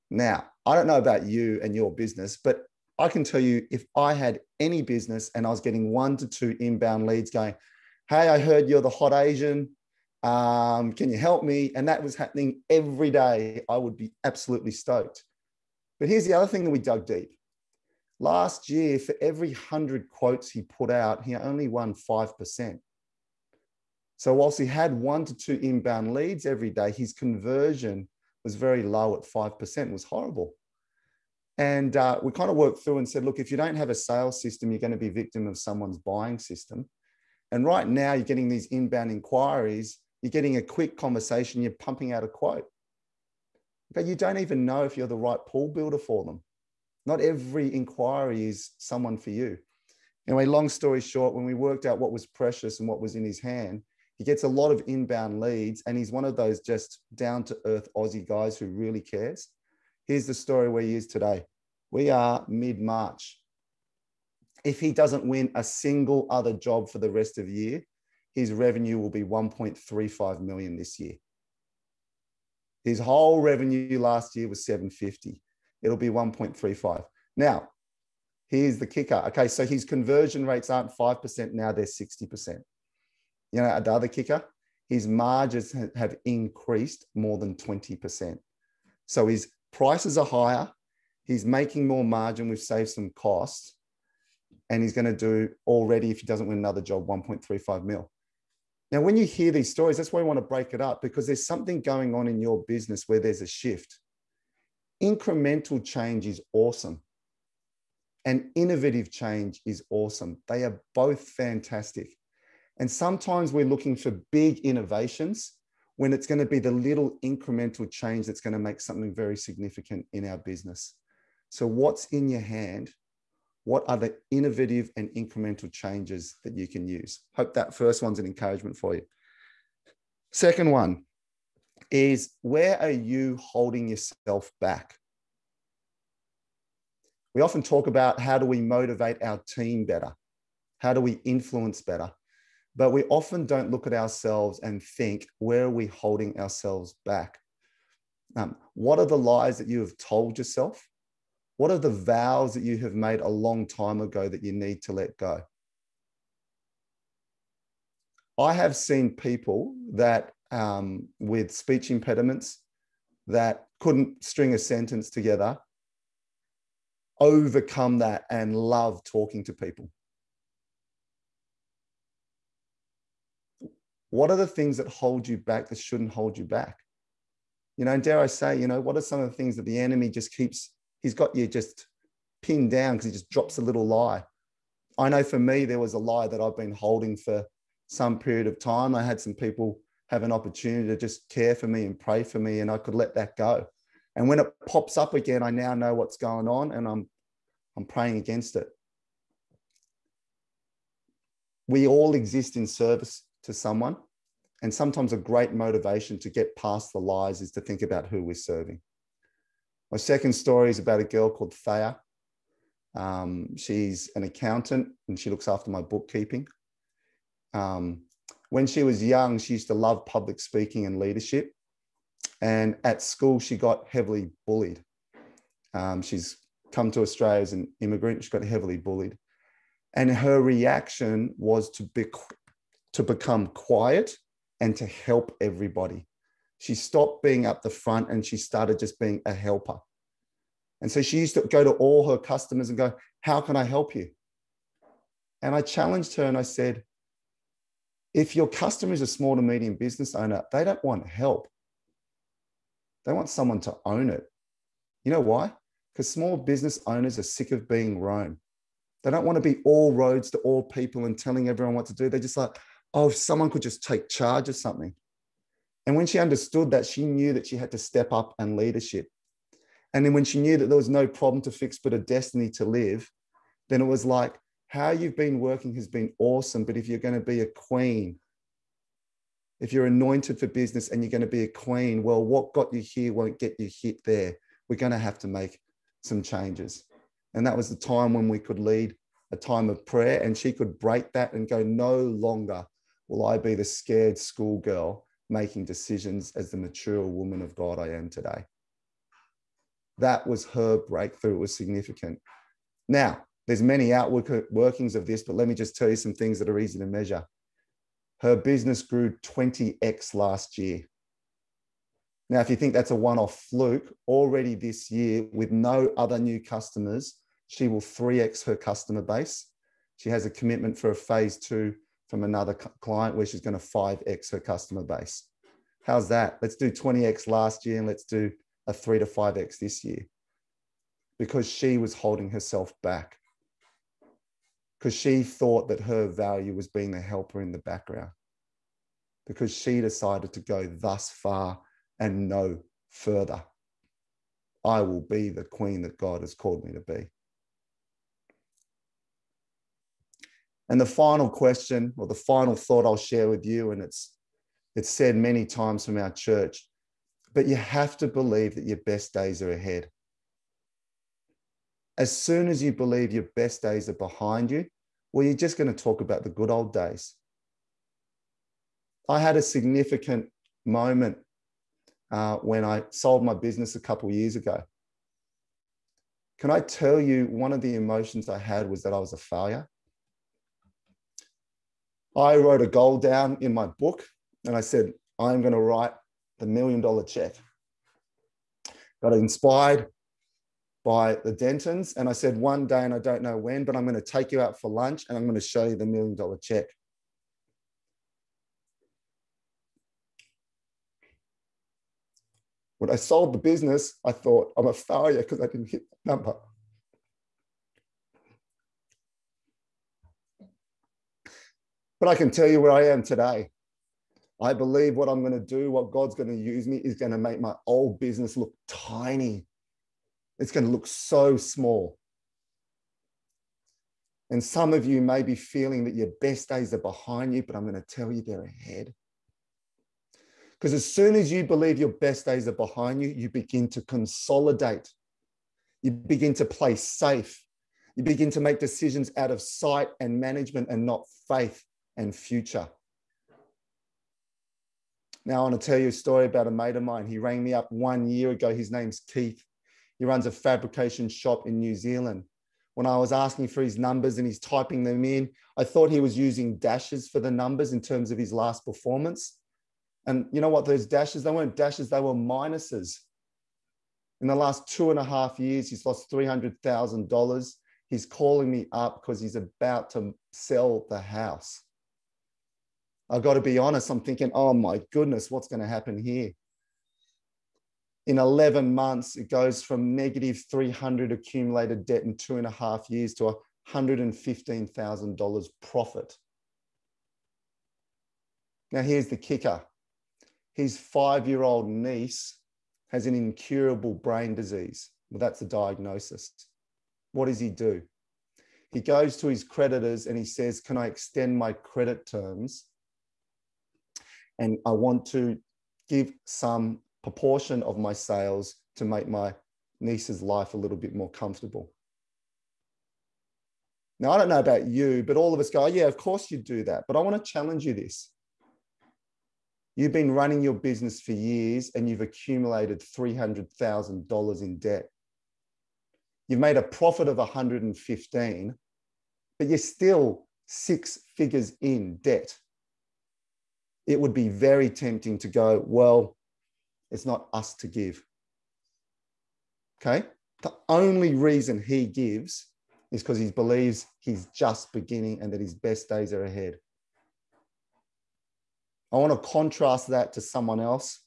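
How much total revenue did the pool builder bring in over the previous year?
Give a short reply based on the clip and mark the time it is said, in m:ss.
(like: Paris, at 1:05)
750, at 1:12.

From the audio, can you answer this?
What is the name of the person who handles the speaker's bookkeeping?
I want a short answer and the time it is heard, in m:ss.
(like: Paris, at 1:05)
Thea, at 3:31.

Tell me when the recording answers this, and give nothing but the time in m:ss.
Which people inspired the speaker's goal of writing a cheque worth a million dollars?
6:31.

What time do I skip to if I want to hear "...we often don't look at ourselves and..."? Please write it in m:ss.
2:22.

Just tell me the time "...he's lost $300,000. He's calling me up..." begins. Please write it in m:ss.
7:45.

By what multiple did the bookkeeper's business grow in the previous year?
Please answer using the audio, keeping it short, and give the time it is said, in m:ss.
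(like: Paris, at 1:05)
20x, at 5:08.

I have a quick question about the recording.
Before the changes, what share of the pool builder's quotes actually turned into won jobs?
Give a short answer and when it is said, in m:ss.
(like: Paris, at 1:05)
5%, at 0:21.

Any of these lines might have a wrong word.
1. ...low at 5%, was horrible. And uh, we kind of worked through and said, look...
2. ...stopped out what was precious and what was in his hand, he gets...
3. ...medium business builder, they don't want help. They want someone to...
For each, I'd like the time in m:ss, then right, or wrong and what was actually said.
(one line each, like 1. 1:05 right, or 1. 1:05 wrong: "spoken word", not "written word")
1. 0:28 right
2. 0:51 wrong: "worked", not "stopped"
3. 4:09 wrong: "owner", not "builder".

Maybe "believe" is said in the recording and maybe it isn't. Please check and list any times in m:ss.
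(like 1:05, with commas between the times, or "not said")
5:58, 6:02, 6:54, 7:11, 9:03.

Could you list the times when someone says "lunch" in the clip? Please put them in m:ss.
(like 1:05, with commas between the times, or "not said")
6:34.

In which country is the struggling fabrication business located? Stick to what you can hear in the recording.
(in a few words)
New Zealand.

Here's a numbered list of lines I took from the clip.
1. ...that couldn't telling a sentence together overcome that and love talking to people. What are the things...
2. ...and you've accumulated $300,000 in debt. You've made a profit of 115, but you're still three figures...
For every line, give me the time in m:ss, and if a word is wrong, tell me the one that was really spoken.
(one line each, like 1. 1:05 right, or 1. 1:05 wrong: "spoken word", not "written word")
1. 2:43 wrong: "string", not "telling"
2. 8:41 wrong: "six", not "three".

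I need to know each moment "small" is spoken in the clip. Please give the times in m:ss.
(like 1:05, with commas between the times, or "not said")
4:09, 4:16, 7:01.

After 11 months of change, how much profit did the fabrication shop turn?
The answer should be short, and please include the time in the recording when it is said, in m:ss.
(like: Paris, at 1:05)
$115,000, at 8:03.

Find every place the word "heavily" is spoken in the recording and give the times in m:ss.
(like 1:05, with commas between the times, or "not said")
3:43, 3:48.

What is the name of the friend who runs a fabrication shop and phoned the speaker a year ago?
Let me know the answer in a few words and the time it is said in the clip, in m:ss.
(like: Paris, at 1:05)
Keith, at 7:28.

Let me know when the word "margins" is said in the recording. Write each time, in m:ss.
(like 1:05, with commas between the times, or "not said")
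1:25, 1:32.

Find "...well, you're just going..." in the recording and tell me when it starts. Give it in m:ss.
6:05.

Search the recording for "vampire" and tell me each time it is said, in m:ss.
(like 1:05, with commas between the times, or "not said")
not said.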